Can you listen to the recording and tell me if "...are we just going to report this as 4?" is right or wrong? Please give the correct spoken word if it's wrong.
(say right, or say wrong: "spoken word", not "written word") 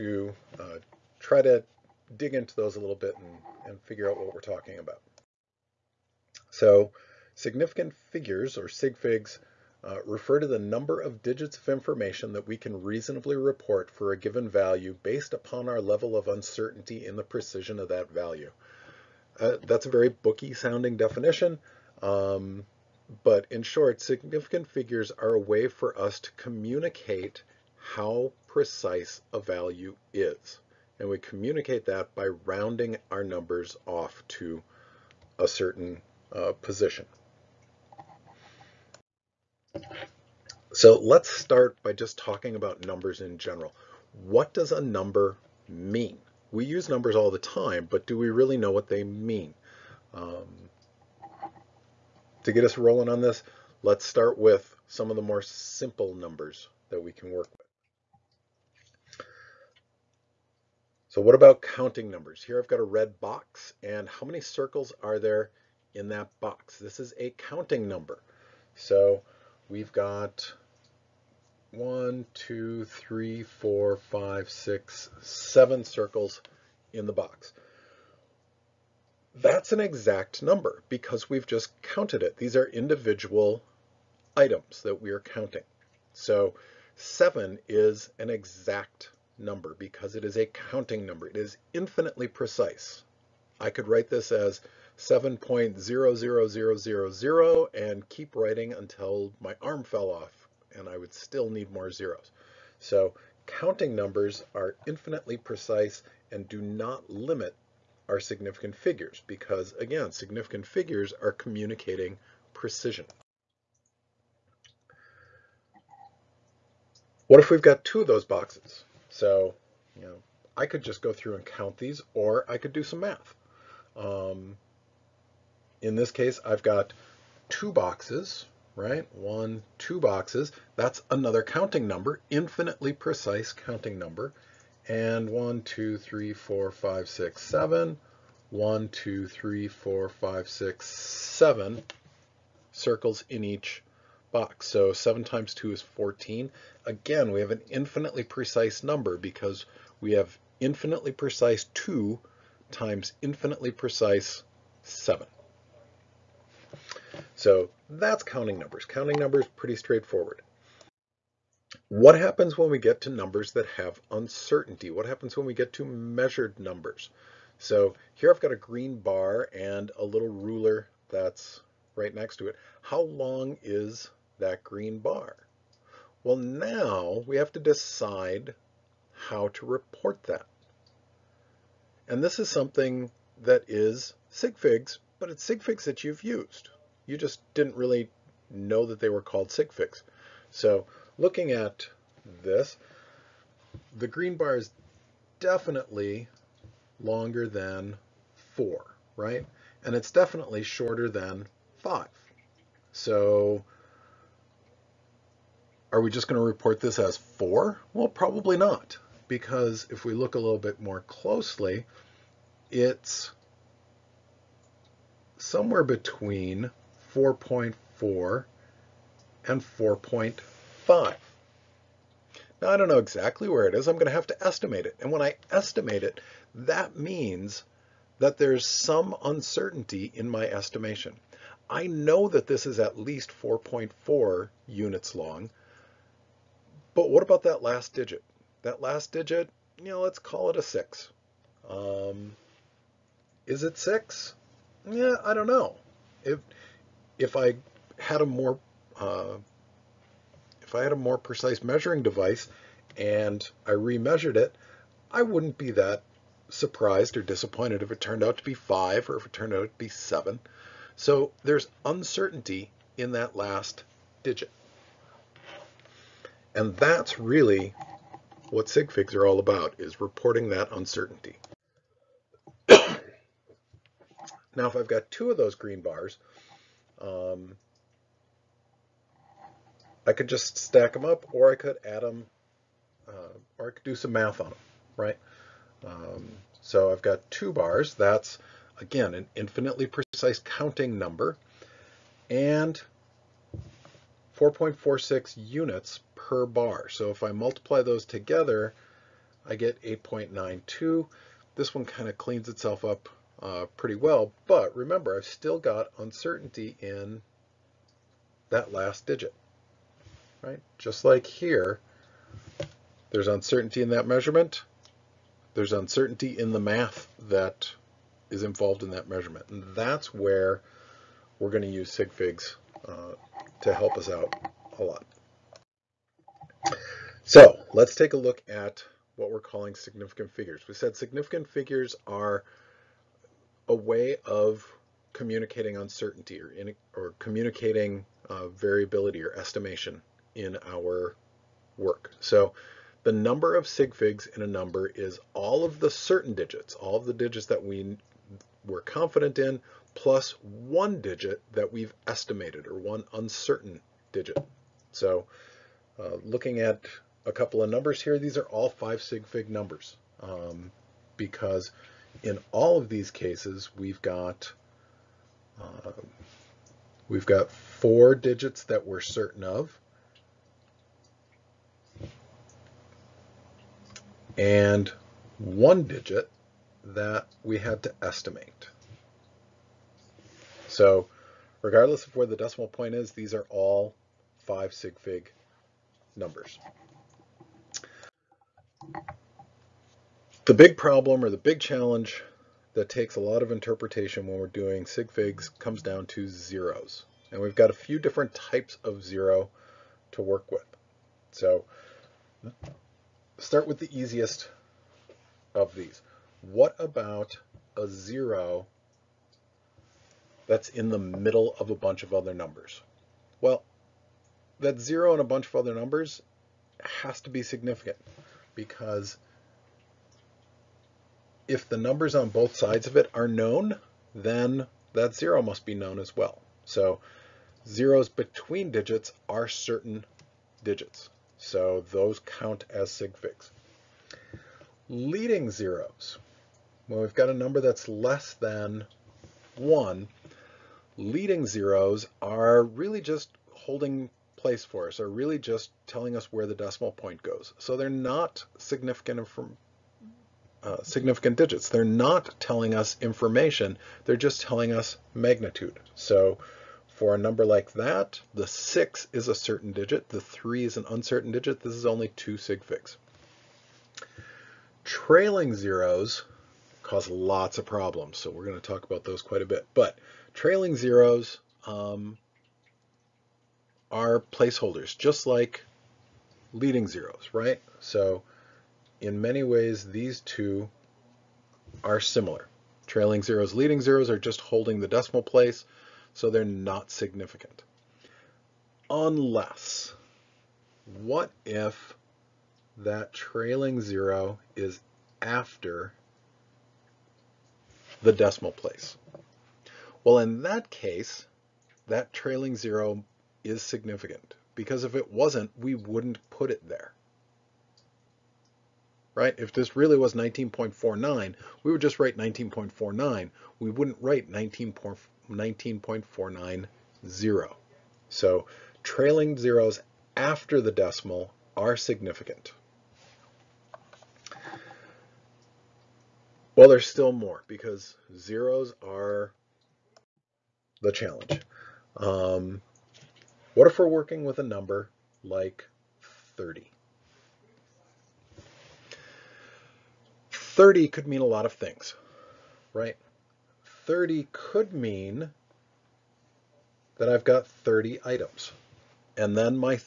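right.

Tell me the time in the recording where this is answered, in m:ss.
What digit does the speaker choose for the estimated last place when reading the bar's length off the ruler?
4:00.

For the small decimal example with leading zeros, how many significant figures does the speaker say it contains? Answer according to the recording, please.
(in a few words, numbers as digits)
2.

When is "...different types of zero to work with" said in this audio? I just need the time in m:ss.
6:37.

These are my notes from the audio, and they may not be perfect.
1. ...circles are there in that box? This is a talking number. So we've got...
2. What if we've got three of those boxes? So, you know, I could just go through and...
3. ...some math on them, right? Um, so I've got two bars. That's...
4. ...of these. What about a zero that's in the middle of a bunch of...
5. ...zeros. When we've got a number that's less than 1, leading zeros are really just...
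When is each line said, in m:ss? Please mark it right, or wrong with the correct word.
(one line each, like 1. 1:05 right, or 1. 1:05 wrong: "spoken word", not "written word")
1. 1:04 wrong: "counting", not "talking"
2. 1:57 wrong: "two", not "three"
3. 4:43 right
4. 6:45 right
5. 7:15 right.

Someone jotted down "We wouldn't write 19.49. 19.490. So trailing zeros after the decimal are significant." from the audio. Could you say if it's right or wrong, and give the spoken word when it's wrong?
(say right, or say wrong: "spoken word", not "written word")
right.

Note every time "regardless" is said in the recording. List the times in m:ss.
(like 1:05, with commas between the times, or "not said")
6:21.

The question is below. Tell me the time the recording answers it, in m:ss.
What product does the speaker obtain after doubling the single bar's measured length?
4:59.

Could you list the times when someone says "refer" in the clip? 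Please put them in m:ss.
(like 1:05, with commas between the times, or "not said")
0:10.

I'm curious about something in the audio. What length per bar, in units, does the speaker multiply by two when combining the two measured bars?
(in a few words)
4.46.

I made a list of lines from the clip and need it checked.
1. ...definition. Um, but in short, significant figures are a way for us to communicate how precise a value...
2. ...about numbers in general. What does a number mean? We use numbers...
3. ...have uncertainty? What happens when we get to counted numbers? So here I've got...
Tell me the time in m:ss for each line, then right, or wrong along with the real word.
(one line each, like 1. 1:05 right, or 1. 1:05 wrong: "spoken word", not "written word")
1. 0:20 right
2. 0:42 right
3. 2:43 wrong: "measured", not "counted".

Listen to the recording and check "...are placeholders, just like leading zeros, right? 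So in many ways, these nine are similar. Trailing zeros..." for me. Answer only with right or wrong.
wrong.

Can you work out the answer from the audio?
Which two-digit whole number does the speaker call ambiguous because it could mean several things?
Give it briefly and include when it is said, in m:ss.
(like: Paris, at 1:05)
30, at 8:54.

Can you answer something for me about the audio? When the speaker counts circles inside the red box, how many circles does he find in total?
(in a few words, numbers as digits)
7.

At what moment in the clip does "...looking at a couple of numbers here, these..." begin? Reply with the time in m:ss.
5:56.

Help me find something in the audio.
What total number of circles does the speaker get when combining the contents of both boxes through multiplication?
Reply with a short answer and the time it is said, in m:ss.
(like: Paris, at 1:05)
14, at 2:24.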